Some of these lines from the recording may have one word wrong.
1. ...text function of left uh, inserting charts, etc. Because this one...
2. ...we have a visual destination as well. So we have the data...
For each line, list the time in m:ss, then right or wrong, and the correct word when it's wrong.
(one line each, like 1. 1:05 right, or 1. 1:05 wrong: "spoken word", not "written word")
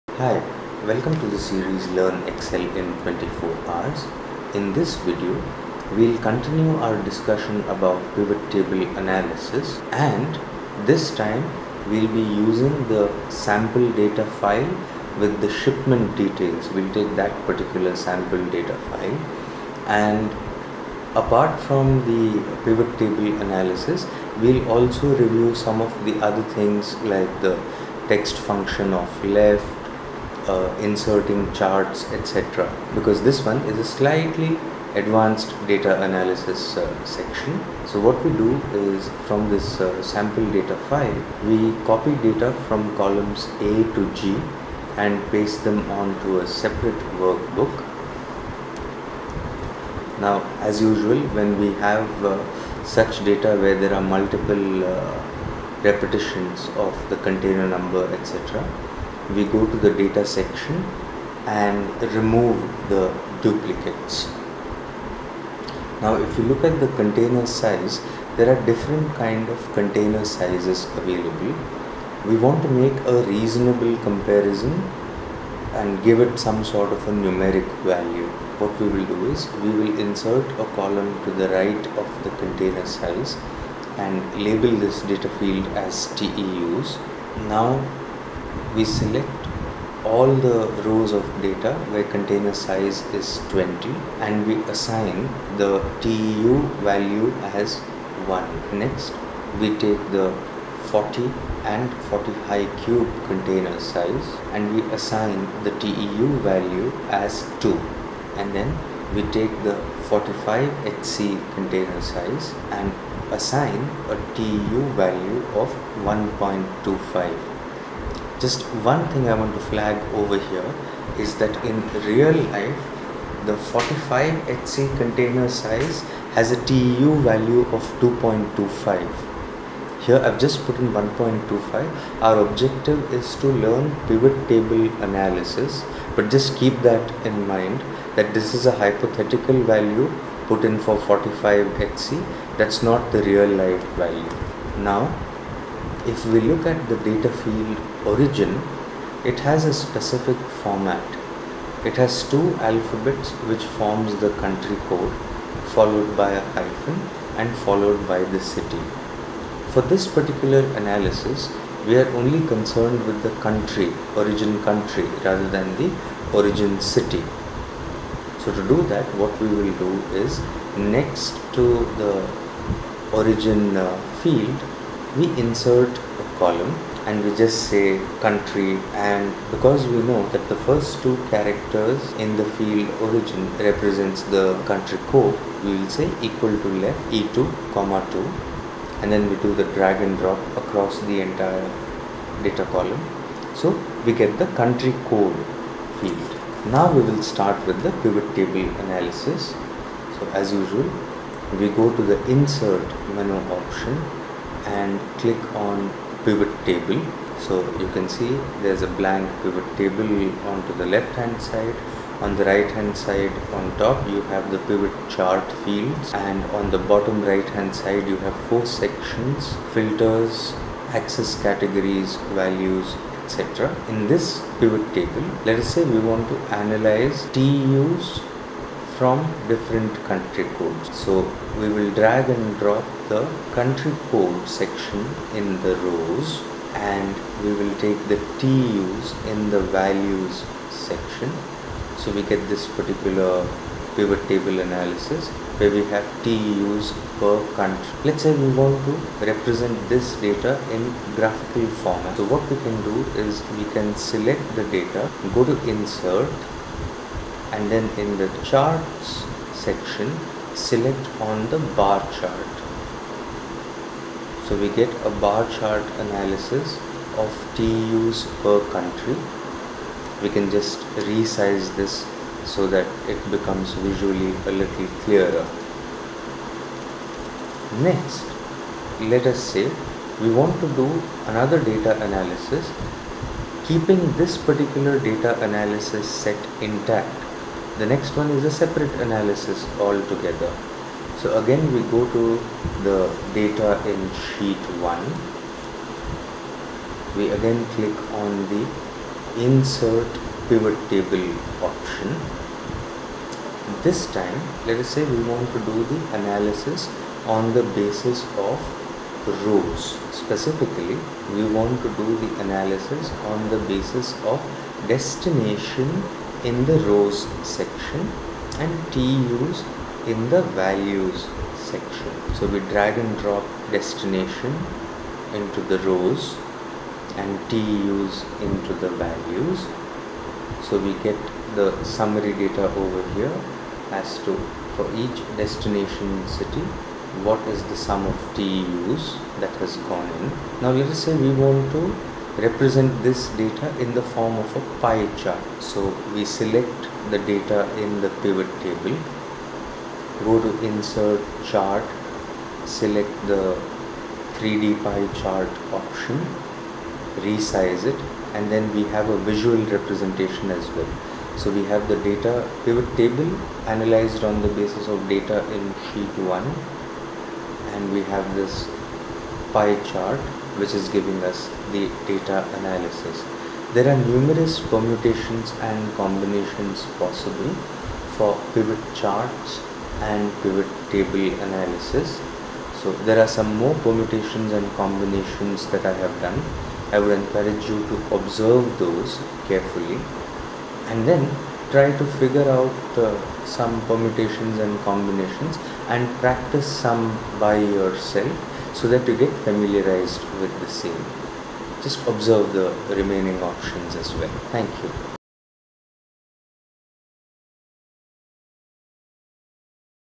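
1. 0:28 right
2. 5:58 wrong: "representation", not "destination".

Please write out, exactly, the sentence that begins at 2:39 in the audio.
For this particular analysis, we are only concerned with the country, origin country, rather than the origin city.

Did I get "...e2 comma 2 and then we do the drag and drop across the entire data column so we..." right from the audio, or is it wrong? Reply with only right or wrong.
right.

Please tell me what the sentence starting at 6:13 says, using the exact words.
There are numerous permutations and combinations possible for pivot charts and pivot table analysis.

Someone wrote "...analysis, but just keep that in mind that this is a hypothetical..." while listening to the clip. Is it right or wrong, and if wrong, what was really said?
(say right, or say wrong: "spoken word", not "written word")
right.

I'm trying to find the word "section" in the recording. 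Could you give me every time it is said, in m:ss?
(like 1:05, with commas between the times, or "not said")
0:37, 1:00, 3:38, 3:54, 4:00, 4:19, 5:17, 5:21.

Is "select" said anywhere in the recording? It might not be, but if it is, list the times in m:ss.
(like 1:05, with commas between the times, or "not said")
1:28, 4:13, 4:20, 5:46, 5:52.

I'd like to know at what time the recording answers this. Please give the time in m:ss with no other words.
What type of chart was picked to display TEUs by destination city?
5:54.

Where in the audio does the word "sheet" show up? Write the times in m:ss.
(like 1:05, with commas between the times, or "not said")
4:54, 6:05.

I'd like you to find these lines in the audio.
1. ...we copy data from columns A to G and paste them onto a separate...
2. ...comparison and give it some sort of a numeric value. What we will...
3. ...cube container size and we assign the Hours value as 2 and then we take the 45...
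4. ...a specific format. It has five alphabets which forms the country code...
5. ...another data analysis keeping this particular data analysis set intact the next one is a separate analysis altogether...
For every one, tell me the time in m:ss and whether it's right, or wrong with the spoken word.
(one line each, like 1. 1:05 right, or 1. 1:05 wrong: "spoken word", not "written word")
1. 0:41 right
2. 1:13 right
3. 1:42 wrong: "TEU", not "Hours"
4. 2:29 wrong: "two", not "five"
5. 4:41 right.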